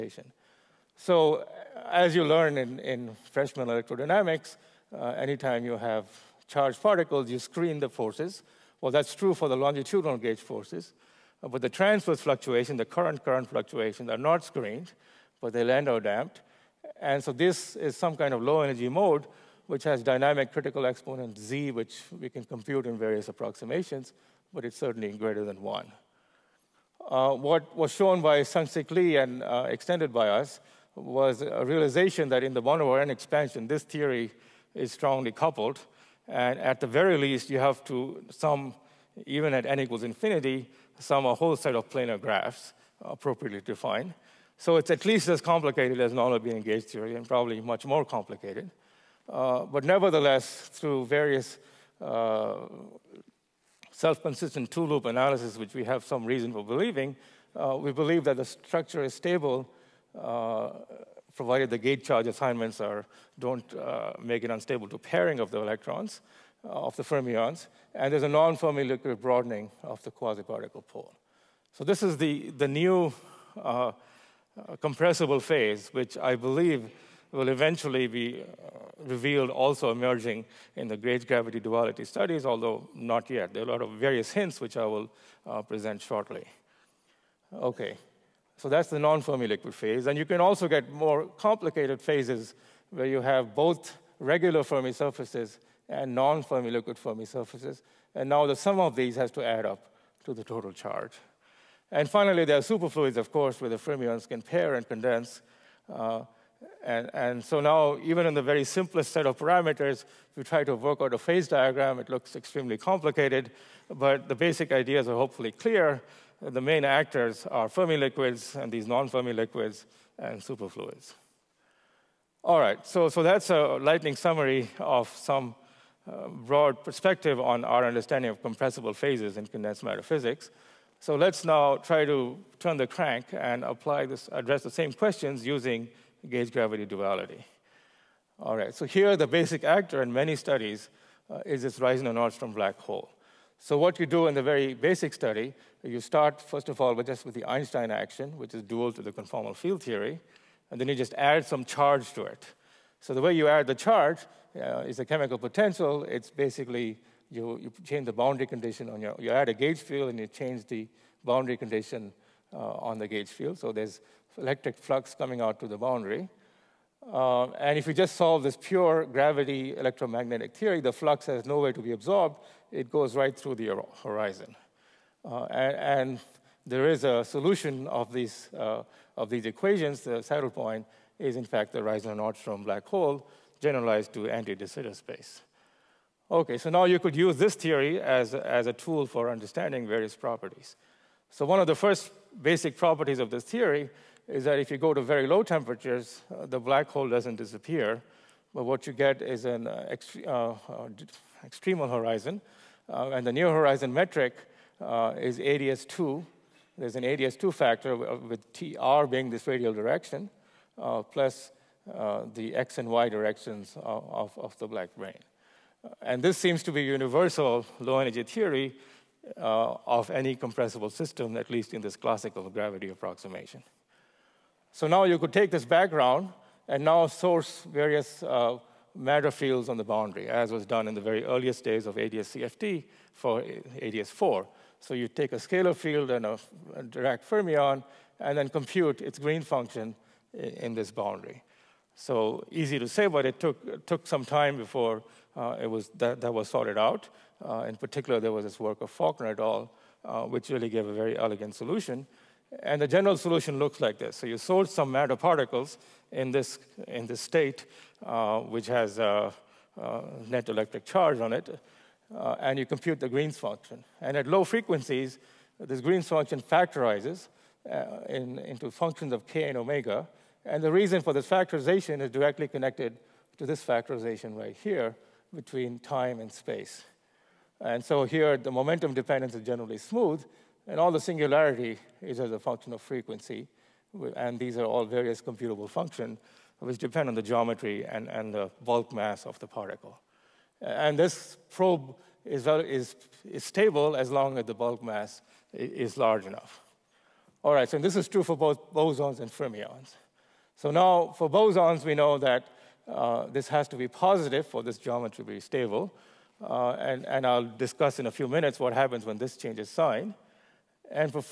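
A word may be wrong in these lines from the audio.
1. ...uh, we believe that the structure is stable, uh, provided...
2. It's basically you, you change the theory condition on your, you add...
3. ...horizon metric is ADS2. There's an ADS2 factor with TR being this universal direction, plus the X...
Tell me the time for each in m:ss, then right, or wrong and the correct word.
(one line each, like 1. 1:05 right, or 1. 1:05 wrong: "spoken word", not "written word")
1. 0:57 right
2. 2:36 wrong: "boundary", not "theory"
3. 3:23 wrong: "radial", not "universal".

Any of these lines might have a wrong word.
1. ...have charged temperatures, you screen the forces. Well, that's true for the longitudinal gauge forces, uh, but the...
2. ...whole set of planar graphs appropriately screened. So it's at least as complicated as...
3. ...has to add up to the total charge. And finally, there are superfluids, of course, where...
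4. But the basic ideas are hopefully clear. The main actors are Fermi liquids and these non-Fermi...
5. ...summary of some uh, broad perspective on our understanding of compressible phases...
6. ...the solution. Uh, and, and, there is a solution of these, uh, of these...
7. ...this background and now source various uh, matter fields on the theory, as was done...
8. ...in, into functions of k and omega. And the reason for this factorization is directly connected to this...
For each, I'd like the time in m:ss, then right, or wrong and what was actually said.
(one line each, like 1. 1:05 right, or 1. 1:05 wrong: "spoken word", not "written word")
1. 0:05 wrong: "particles", not "temperatures"
2. 0:41 wrong: "defined", not "screened"
3. 1:39 right
4. 1:53 right
5. 2:04 right
6. 2:53 wrong: "horizon", not "solution"
7. 3:45 wrong: "boundary", not "theory"
8. 4:28 right.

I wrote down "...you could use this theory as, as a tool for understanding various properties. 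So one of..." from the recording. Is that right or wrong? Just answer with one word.
right.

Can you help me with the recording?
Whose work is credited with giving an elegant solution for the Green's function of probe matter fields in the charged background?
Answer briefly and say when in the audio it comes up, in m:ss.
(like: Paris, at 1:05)
Faulkner et al., at 4:08.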